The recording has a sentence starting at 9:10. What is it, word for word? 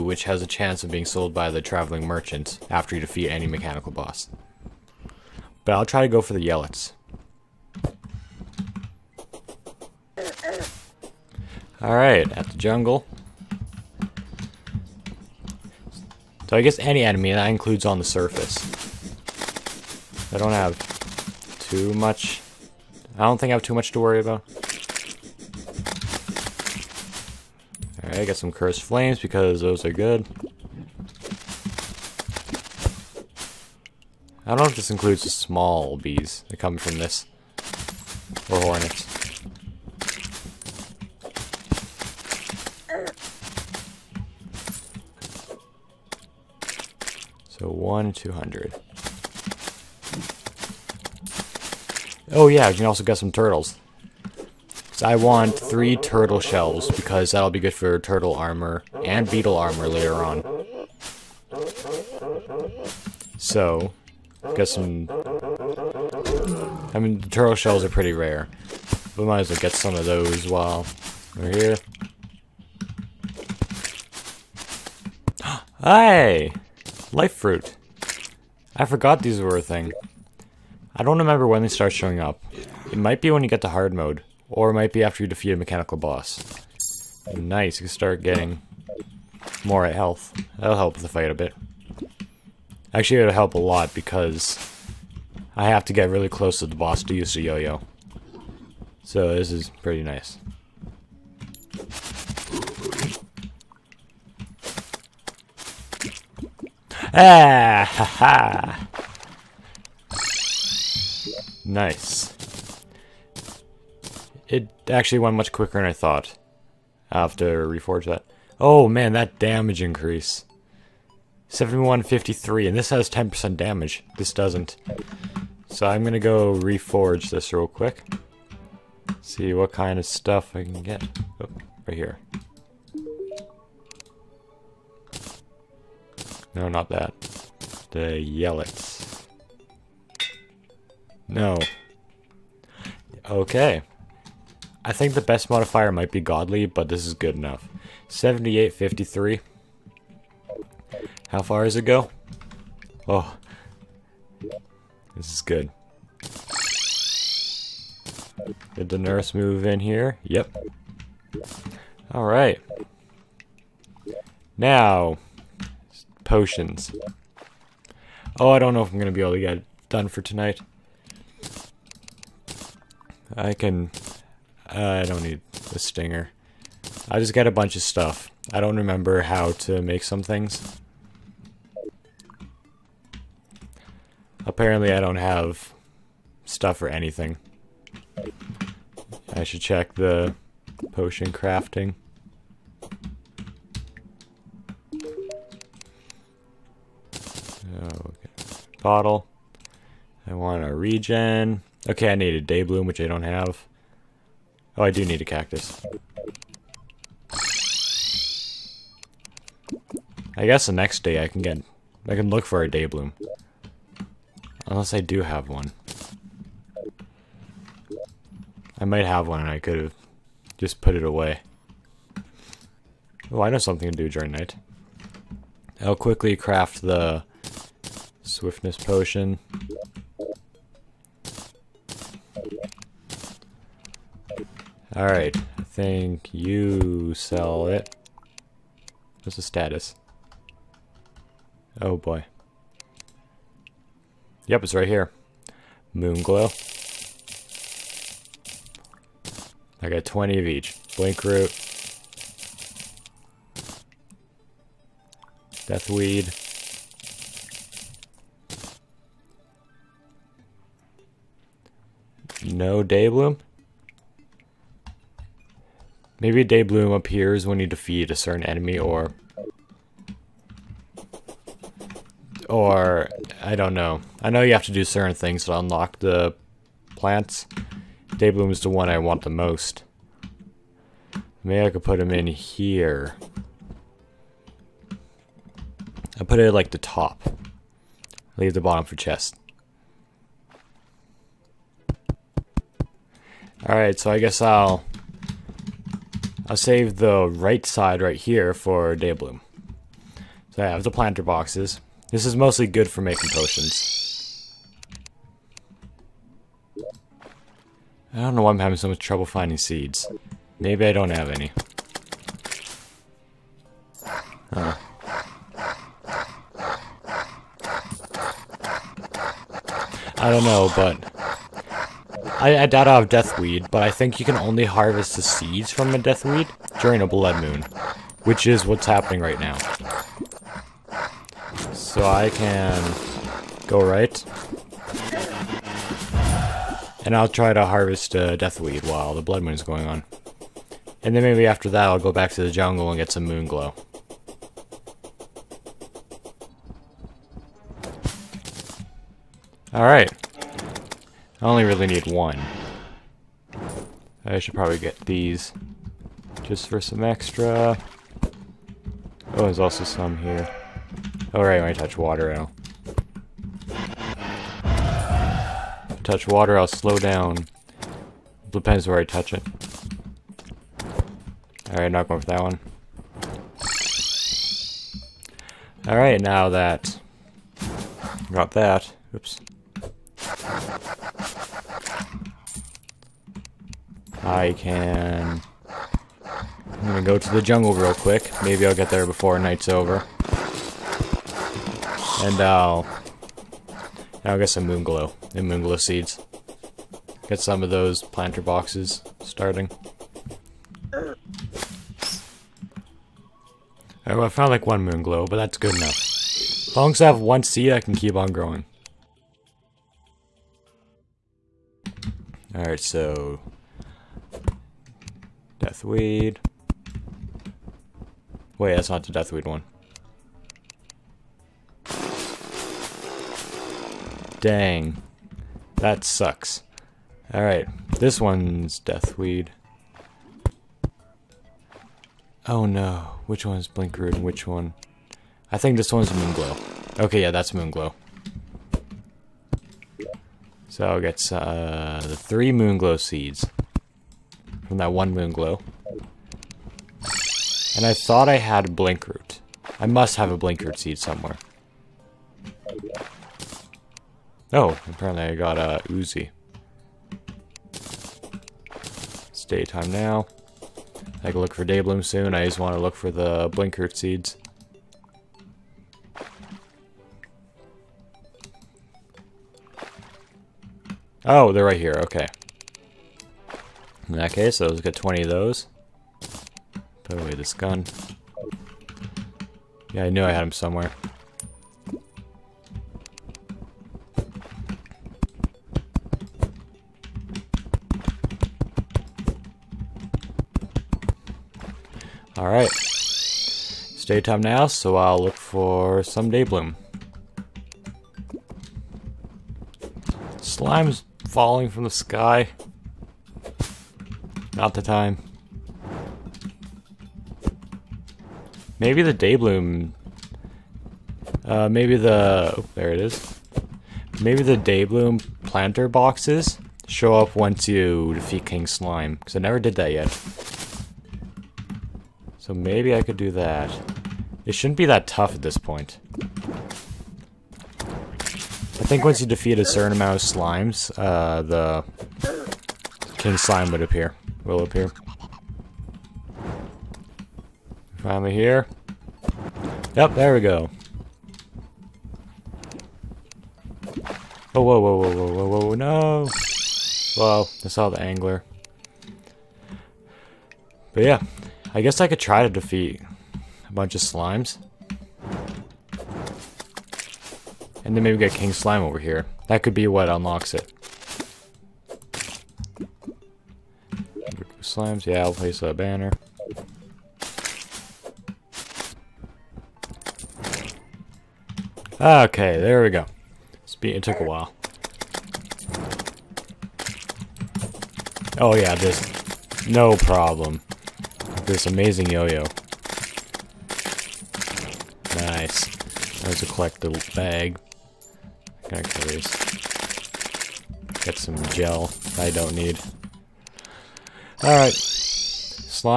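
But yeah, I guess I could try to defeat a bunch of slimes.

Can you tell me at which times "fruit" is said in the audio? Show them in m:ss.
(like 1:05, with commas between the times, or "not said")
1:17.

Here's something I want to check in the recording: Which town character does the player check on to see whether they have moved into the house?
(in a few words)
The nurse.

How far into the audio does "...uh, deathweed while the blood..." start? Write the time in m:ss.
5:38.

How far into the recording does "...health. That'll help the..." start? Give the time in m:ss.
1:29.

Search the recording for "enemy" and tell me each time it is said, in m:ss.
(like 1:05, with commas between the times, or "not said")
0:17, 4:28.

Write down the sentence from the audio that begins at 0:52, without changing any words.
Oh yeah, you can also get some turtles.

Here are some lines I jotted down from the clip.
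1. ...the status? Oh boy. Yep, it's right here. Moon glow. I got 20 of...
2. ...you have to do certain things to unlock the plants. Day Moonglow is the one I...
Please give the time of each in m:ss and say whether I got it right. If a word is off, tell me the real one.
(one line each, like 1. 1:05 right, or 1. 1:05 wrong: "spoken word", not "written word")
1. 3:59 right
2. 4:34 wrong: "Bloom", not "Moonglow".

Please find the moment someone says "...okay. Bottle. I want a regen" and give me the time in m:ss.
3:18.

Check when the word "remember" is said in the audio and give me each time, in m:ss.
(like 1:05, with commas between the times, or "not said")
1:21, 2:58.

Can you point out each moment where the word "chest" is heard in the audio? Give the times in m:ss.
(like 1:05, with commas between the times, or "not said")
4:48.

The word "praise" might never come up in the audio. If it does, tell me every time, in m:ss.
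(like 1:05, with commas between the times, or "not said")
not said.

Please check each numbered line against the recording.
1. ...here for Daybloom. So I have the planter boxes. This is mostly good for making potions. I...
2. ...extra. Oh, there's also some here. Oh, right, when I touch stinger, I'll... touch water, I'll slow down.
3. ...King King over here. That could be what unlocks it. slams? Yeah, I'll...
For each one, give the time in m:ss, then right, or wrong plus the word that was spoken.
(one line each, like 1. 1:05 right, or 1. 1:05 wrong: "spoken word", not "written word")
1. 4:58 right
2. 5:57 wrong: "water", not "stinger"
3. 9:18 wrong: "Slime", not "King".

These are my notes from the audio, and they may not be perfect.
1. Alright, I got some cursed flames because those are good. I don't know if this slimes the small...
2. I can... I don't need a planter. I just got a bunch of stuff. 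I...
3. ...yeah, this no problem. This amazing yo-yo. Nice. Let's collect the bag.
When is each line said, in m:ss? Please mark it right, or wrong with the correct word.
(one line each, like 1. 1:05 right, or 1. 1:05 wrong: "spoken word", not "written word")
1. 0:28 wrong: "includes", not "slimes"
2. 2:53 wrong: "stinger", not "planter"
3. 9:38 right.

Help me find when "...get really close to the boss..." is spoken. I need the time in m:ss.
1:35.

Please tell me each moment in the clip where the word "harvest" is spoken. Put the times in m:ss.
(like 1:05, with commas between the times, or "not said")
5:24, 5:37.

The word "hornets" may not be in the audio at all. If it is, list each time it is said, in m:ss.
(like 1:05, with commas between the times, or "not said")
0:38.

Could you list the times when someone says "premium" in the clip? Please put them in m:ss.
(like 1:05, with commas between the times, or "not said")
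not said.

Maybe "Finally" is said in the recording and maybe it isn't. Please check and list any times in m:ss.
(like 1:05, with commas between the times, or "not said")
8:57.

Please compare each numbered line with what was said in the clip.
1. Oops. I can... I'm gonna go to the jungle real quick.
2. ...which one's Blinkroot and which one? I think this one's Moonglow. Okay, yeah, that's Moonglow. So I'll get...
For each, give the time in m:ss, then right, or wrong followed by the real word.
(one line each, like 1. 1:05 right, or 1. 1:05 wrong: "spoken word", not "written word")
1. 6:19 right
2. 7:13 right.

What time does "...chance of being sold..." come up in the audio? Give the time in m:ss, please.
0:00.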